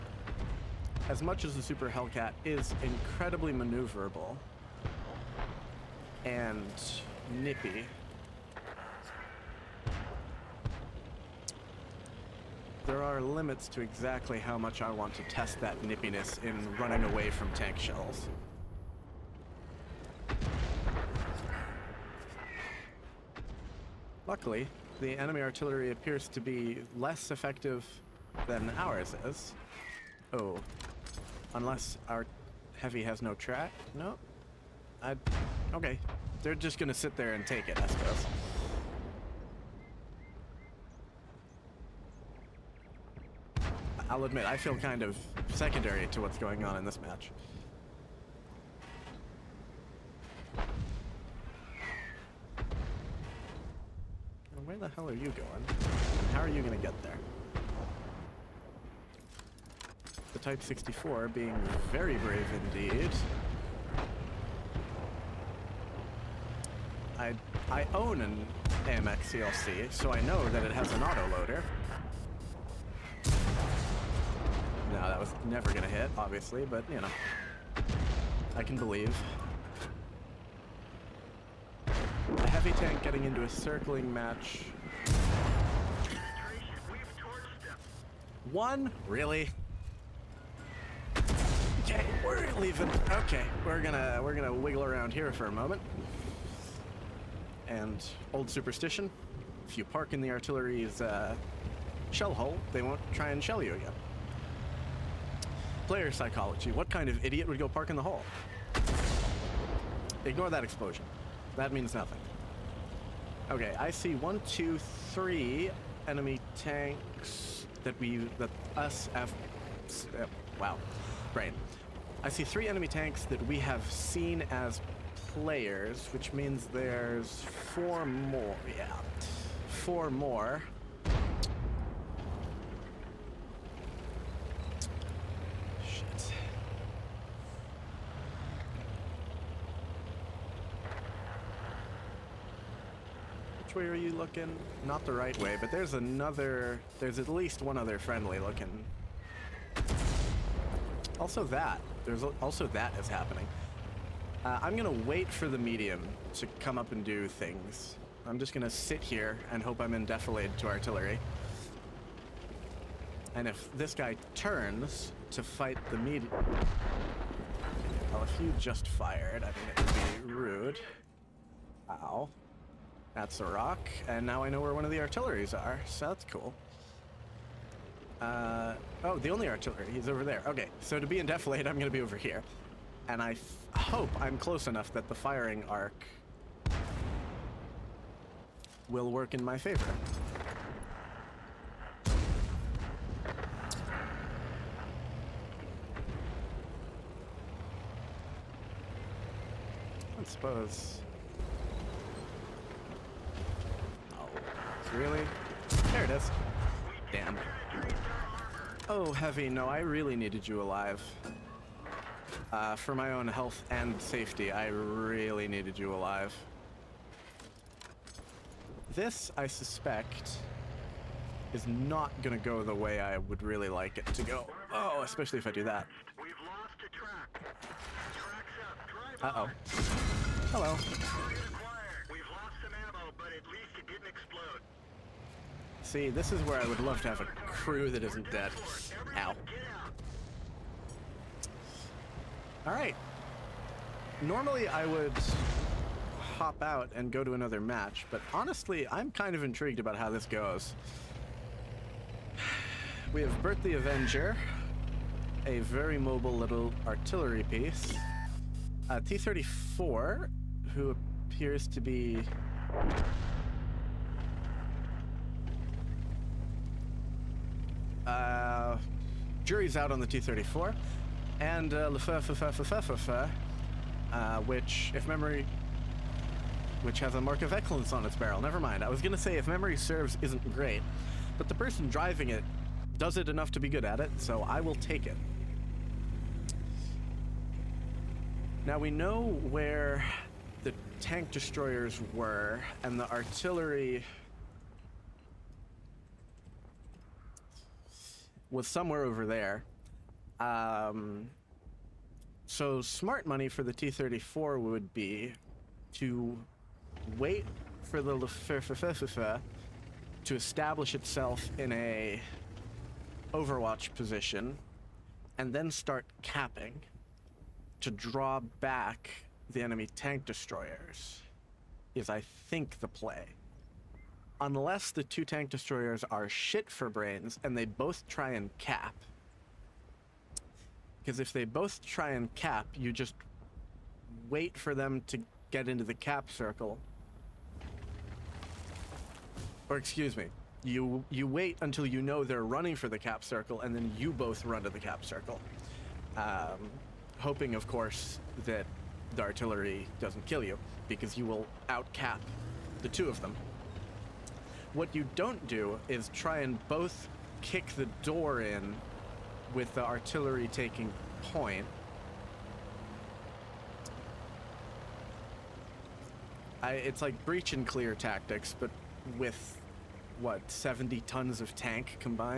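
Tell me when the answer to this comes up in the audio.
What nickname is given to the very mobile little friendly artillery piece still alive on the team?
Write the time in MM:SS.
04:13.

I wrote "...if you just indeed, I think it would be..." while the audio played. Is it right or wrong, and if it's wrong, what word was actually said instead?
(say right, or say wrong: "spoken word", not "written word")
wrong: "fired", not "indeed".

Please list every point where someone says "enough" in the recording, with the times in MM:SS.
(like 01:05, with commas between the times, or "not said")
03:04, 04:43.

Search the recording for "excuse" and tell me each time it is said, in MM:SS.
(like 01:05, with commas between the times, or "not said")
05:39.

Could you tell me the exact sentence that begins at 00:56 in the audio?
How are you going to get there?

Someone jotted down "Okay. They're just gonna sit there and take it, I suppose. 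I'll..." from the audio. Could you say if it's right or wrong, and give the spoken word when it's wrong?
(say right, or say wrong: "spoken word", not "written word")
right.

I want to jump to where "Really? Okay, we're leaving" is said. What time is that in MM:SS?
01:29.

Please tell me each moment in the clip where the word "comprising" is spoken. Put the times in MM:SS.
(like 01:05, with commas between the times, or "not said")
not said.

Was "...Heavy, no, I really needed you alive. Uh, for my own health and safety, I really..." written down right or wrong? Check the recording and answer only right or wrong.
right.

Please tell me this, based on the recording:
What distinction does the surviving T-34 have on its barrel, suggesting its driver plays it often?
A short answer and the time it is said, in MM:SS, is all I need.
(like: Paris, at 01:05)
mark of excellence, at 04:37.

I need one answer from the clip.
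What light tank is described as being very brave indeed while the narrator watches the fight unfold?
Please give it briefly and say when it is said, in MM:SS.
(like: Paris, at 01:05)
Type 64, at 01:00.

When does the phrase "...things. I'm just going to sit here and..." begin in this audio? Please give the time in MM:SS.
02:37.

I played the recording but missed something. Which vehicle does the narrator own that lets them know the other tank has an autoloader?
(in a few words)
AMX CLC.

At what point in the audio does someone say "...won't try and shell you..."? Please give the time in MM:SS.
01:42.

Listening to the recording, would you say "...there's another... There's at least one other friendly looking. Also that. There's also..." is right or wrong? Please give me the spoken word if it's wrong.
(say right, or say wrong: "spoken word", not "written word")
right.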